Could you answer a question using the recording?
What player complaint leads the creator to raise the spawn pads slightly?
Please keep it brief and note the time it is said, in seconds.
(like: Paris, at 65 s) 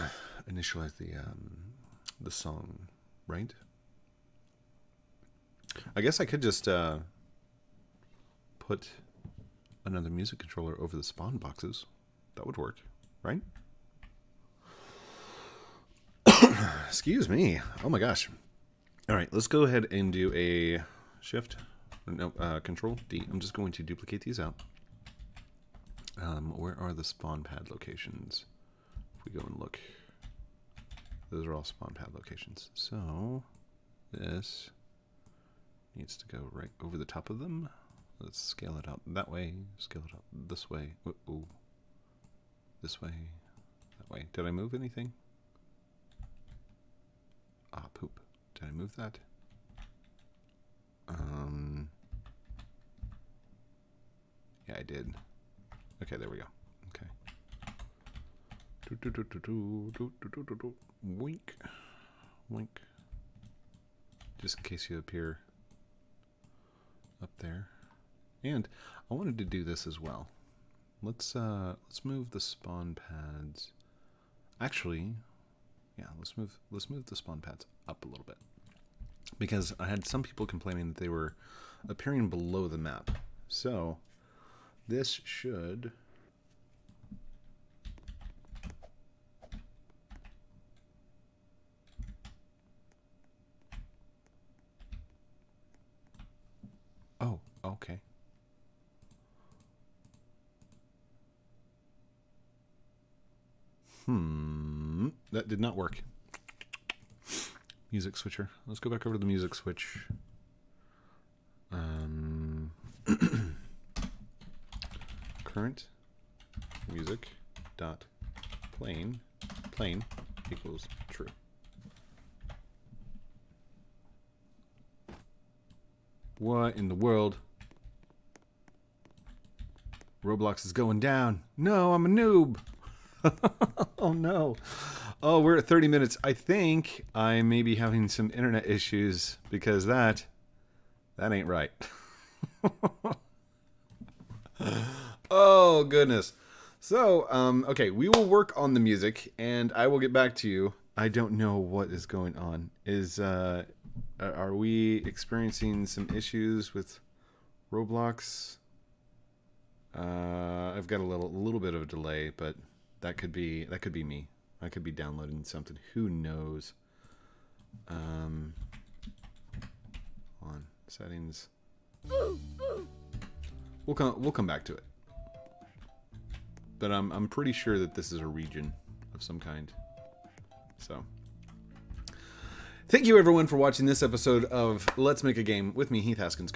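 Appearing below the map, at 81 s.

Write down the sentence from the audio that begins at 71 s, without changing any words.
Let's uh, let's move the spawn pads.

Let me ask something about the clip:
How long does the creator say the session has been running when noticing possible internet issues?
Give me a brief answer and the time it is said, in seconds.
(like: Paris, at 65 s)
30 minutes, at 135 s.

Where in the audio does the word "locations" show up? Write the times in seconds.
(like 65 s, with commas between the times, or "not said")
27 s, 32 s.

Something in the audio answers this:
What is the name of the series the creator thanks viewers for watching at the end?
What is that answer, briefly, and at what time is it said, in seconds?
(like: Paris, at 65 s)
Let's Make a Game, at 184 s.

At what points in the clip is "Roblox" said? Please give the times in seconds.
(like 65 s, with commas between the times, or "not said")
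130 s, 157 s.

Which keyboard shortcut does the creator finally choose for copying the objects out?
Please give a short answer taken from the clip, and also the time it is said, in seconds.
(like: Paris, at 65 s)
Control D, at 22 s.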